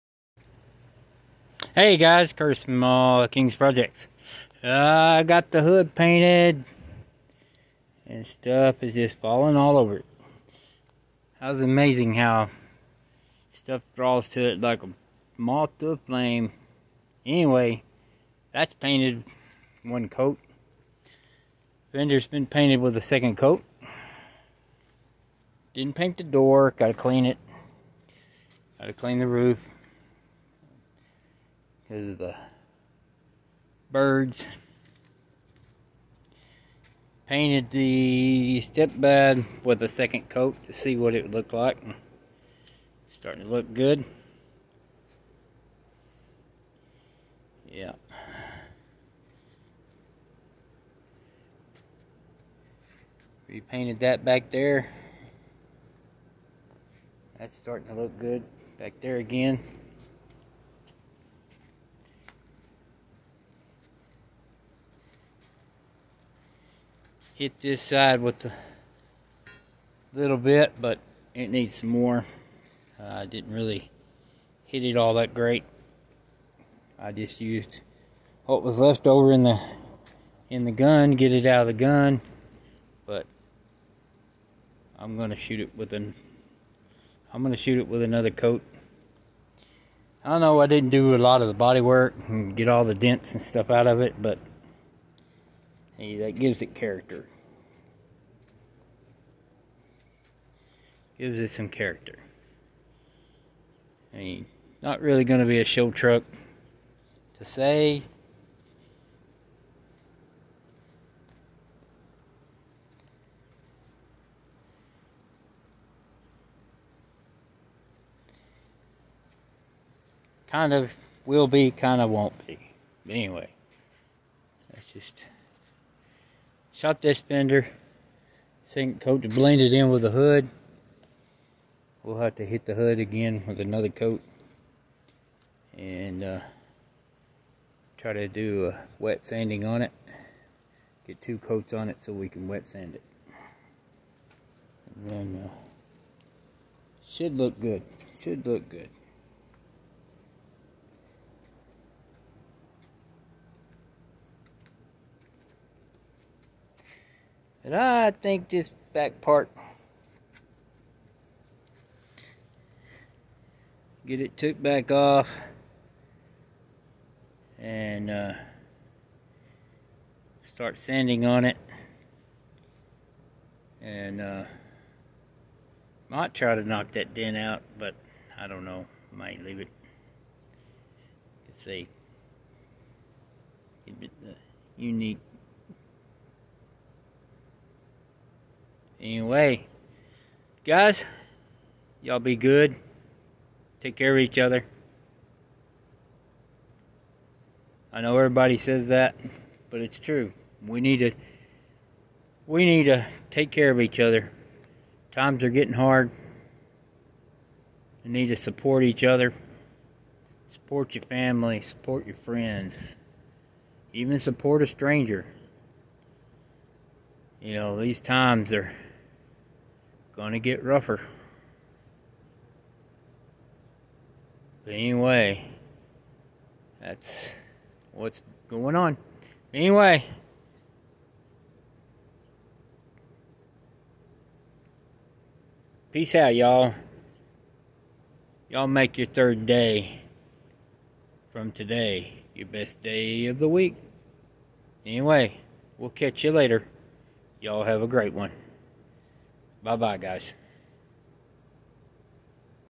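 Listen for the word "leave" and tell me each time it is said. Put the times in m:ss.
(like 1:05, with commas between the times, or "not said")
2:59.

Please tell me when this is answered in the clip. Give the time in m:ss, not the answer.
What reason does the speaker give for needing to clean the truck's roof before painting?
0:31.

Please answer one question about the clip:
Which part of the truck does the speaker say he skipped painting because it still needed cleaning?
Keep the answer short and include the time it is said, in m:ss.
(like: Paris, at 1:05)
The door, at 0:26.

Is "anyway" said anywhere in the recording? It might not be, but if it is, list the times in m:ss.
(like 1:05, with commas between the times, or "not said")
0:17, 2:03, 3:09, 3:44, 3:49, 4:04.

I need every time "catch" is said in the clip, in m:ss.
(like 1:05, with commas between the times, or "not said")
4:05.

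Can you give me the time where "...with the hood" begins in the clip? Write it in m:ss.
2:09.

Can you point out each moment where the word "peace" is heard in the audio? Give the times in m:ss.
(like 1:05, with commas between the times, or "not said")
3:55.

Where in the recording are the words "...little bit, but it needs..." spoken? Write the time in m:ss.
1:10.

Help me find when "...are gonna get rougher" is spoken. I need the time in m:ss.
3:38.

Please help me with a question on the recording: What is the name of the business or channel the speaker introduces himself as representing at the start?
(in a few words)
King's Projects.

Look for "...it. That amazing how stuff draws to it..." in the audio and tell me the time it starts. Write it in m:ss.
0:09.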